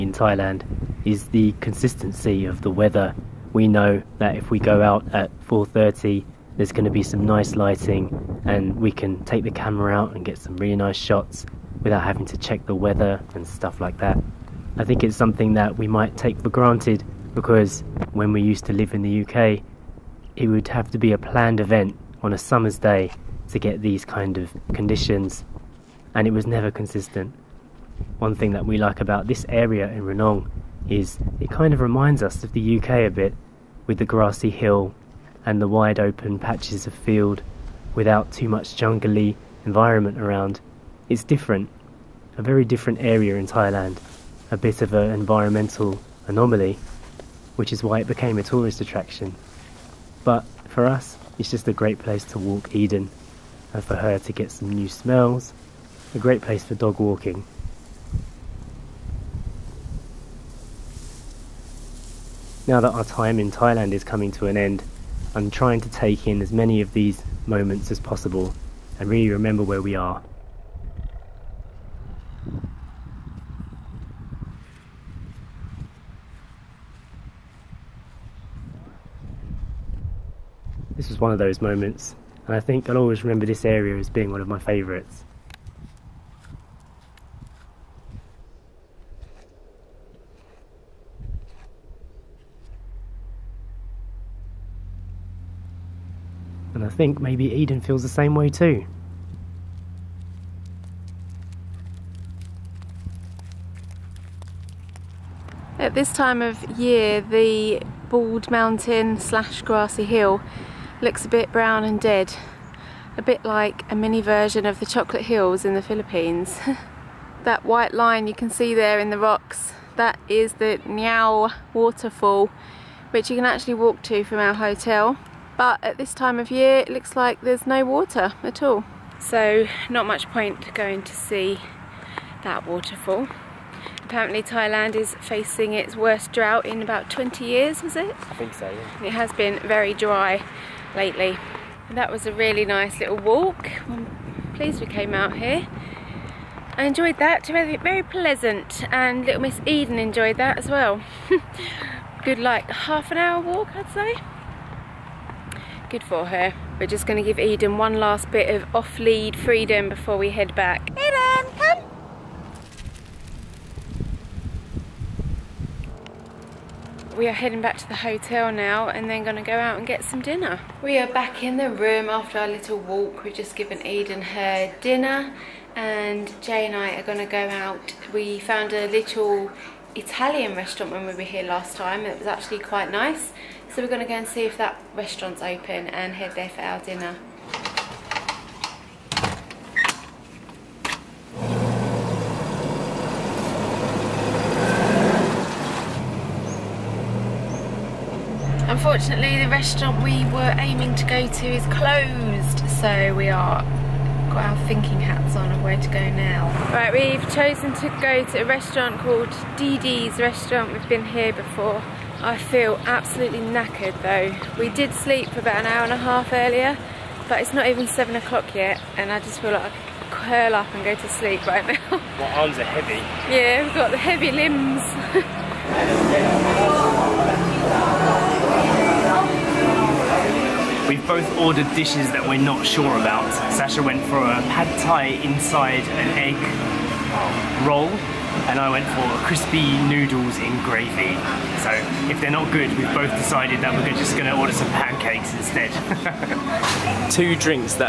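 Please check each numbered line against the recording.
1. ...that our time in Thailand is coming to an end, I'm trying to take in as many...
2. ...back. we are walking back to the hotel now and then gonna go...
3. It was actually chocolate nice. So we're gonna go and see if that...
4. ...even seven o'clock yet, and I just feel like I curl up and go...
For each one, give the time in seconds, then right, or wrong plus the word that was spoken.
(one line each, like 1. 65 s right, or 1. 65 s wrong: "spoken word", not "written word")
1. 62 s right
2. 160 s wrong: "heading", not "walking"
3. 182 s wrong: "quite", not "chocolate"
4. 217 s right.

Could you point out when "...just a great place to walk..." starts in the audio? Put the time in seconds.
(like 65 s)
51 s.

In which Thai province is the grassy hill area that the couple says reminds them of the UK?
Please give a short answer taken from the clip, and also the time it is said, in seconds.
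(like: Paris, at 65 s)
Ranong, at 30 s.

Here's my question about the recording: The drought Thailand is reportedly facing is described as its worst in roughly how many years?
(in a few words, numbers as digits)
20.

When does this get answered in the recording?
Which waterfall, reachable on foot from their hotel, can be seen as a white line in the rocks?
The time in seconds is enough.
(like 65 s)
120 s.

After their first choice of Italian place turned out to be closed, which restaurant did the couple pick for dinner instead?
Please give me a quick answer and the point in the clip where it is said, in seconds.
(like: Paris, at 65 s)
Dee Dee's restaurant, at 209 s.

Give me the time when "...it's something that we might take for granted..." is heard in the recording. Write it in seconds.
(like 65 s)
15 s.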